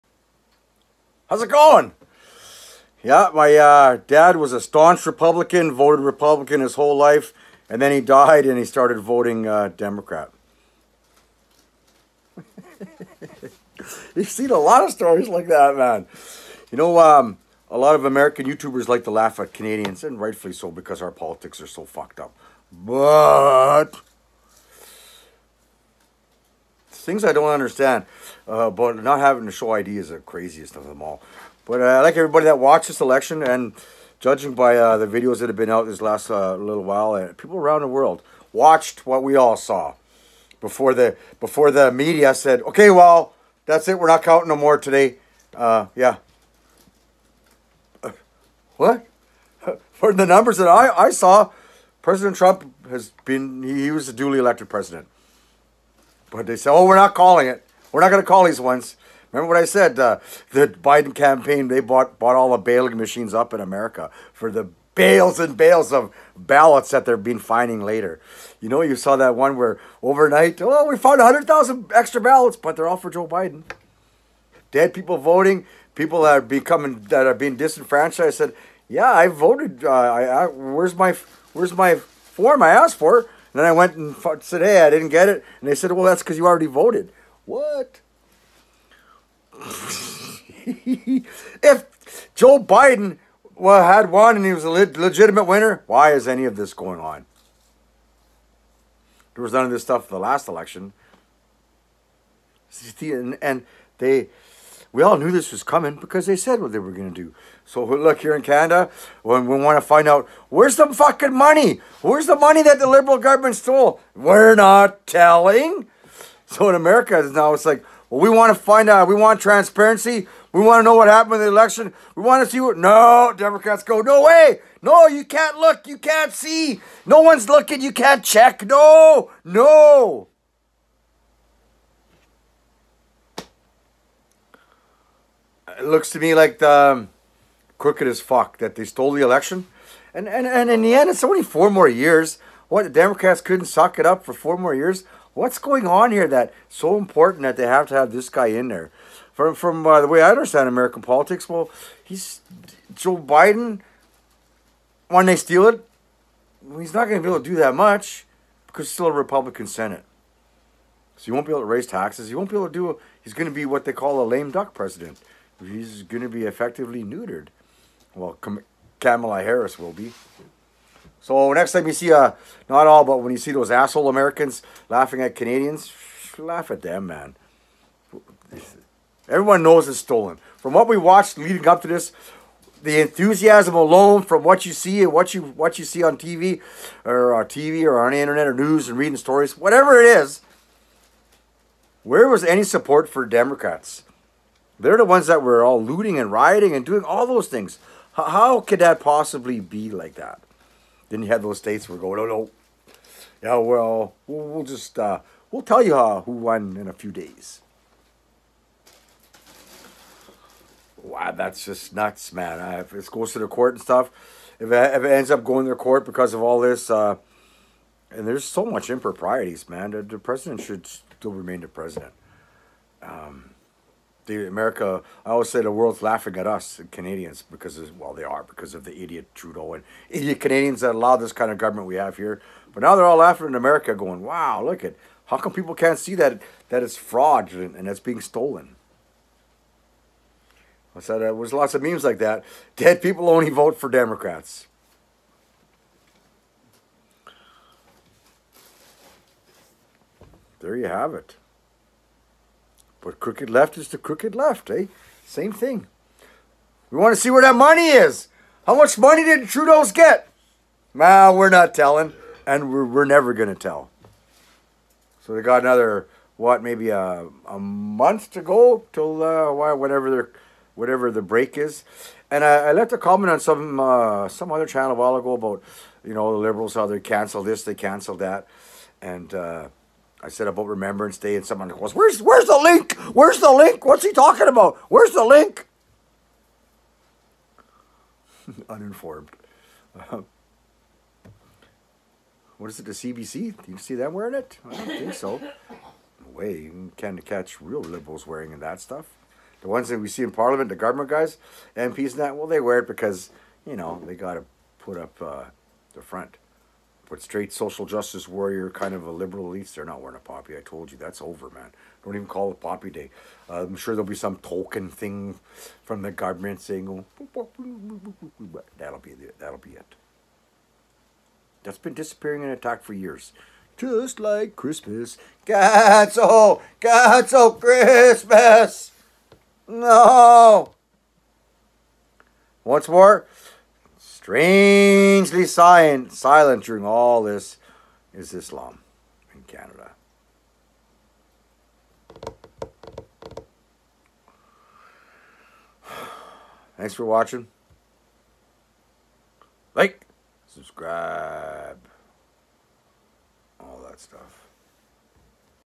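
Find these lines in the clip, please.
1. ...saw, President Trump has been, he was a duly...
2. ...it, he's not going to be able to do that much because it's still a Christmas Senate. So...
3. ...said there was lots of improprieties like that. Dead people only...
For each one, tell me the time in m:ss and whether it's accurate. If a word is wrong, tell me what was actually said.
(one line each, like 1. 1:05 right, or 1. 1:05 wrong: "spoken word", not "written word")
1. 0:51 right
2. 2:35 wrong: "Republican", not "Christmas"
3. 4:01 wrong: "memes", not "improprieties".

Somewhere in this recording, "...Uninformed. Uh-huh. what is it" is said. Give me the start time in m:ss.
4:48.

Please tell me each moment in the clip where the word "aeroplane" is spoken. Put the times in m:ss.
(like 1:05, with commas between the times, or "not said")
not said.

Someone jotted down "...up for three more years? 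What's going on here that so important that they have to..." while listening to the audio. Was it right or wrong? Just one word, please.
wrong.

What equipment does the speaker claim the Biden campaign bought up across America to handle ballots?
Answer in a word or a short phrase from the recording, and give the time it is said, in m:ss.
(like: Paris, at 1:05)
baling machines, at 1:02.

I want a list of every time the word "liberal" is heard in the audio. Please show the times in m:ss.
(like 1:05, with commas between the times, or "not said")
1:52, 4:36, 4:57, 5:09.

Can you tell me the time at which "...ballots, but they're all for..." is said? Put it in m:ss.
1:12.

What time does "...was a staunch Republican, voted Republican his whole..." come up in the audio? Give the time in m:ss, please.
0:04.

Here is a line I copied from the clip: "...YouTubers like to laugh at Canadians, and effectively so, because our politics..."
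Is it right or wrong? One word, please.
wrong.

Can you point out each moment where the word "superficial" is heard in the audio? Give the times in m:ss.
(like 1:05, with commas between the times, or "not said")
not said.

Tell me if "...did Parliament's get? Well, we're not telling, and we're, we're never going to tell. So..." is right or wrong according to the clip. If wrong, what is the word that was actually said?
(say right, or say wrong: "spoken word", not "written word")
wrong: "Trudeau", not "Parliament".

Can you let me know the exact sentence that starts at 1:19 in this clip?
Uh, I, I, where's my where's my form I asked for?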